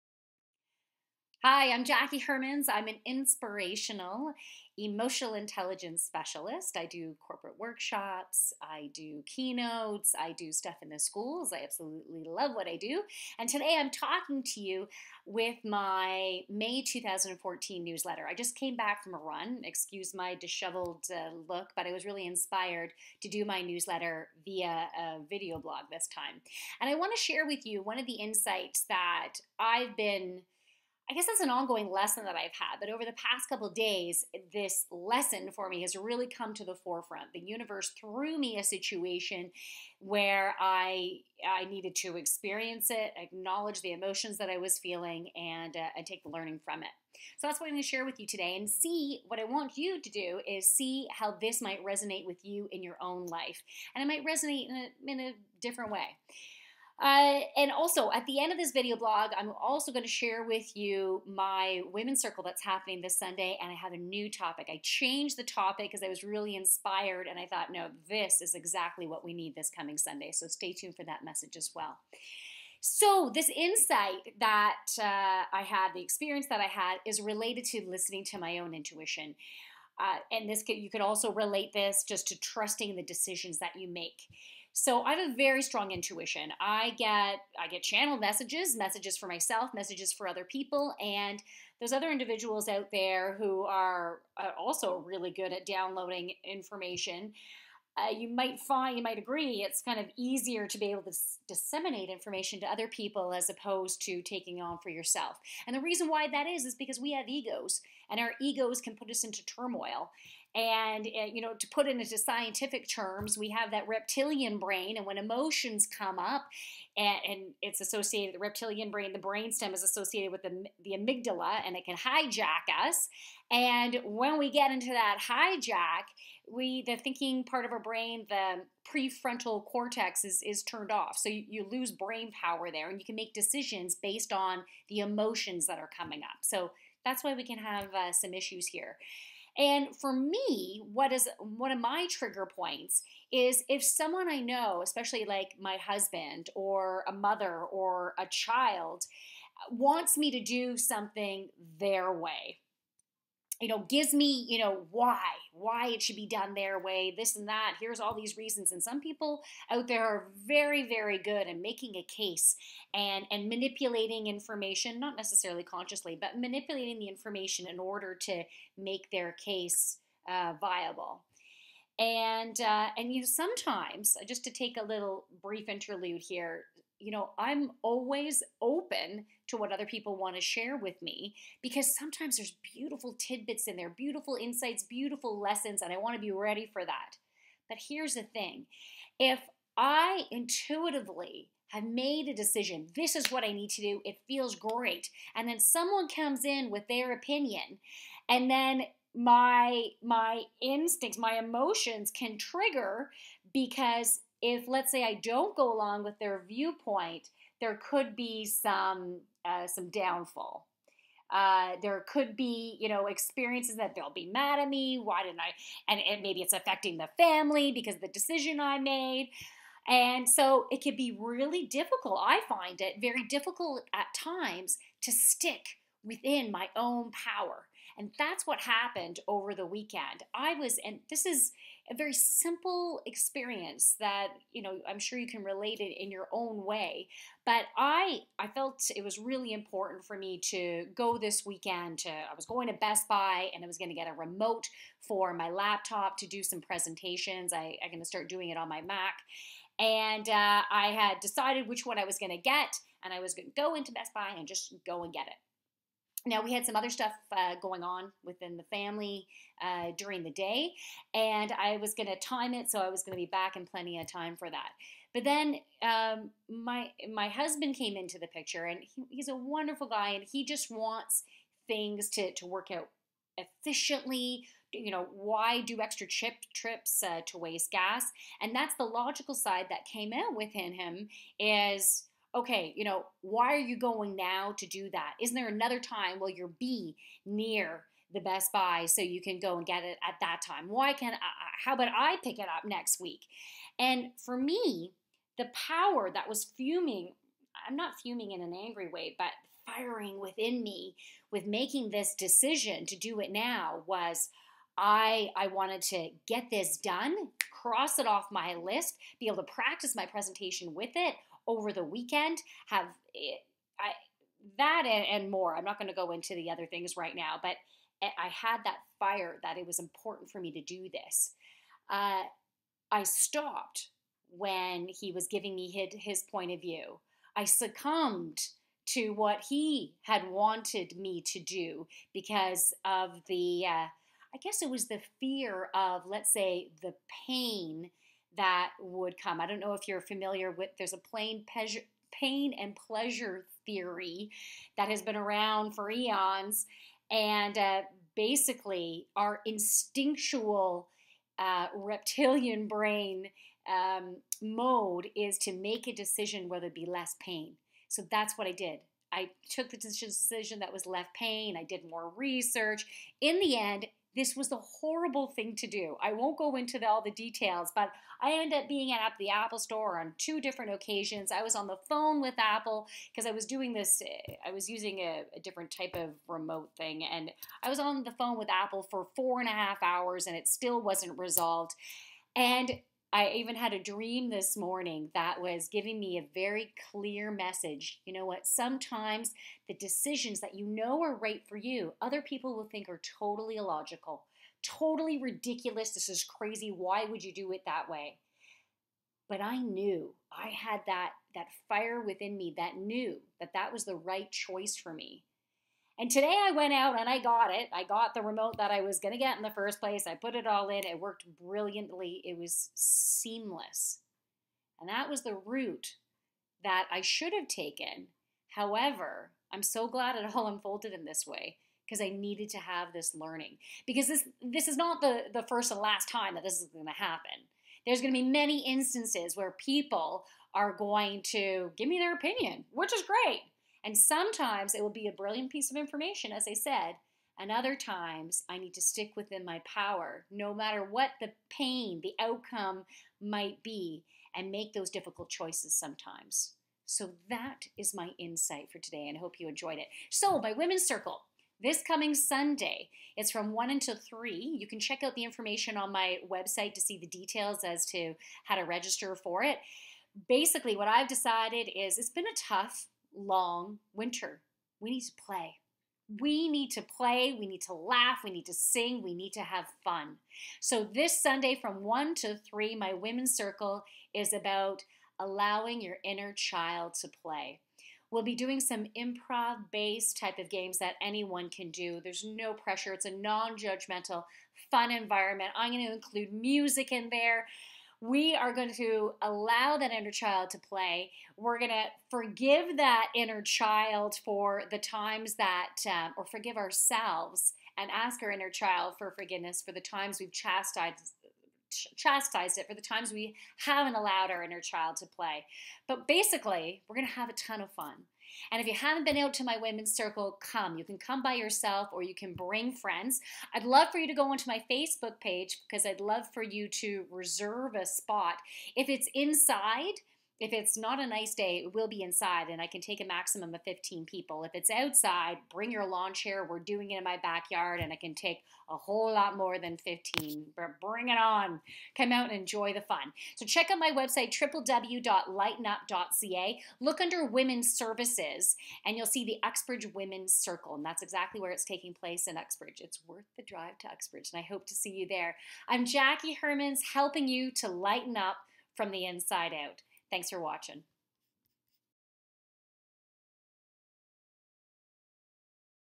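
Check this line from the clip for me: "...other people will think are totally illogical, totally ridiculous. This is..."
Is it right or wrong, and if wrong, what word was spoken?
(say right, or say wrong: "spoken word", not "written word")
right.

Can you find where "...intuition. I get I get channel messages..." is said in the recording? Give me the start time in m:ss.
1:25.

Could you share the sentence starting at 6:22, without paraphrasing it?
And I even had a dream this morning that was giving me a very clear message.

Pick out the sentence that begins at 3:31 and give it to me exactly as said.
Uh, there could be, you know, experiences that they'll be mad at me.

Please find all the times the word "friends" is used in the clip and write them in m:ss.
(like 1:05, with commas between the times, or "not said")
8:32.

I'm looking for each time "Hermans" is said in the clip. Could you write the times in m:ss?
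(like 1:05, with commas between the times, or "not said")
0:02, 9:06.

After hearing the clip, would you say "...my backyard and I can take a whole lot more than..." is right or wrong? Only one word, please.
right.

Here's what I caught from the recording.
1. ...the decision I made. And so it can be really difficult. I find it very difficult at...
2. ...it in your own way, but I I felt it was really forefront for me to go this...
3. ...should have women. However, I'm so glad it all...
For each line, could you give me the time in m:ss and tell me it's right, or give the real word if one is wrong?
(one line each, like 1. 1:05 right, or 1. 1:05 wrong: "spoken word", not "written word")
1. 3:38 right
2. 3:55 wrong: "important", not "forefront"
3. 6:57 wrong: "taken", not "women".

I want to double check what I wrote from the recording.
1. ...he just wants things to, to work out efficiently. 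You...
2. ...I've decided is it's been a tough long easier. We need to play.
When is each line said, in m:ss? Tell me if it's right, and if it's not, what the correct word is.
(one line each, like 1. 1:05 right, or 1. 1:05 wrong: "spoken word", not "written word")
1. 4:30 right
2. 7:40 wrong: "winter", not "easier".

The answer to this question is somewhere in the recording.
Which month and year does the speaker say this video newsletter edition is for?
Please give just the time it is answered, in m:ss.
0:16.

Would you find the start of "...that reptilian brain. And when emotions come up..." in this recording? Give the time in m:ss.
1:53.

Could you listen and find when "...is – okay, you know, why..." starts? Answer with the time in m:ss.
4:41.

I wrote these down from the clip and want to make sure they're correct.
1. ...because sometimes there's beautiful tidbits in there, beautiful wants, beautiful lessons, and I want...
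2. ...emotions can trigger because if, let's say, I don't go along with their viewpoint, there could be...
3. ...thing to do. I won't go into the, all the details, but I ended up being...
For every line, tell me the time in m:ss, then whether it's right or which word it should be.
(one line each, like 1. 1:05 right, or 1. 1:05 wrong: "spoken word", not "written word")
1. 3:01 wrong: "insights", not "wants"
2. 3:21 right
3. 6:05 right.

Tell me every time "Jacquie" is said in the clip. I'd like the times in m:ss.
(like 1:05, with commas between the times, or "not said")
0:01, 9:05.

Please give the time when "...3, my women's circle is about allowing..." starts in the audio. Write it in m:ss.
7:52.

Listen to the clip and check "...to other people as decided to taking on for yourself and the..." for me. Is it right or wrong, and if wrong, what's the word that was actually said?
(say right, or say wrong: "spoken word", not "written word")
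wrong: "opposed", not "decided".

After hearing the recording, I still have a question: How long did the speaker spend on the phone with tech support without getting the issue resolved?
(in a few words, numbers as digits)
4.5 hours.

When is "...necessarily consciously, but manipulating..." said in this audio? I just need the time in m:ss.
2:45.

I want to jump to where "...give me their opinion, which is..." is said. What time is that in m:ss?
7:11.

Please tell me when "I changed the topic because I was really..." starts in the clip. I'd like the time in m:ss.
1:04.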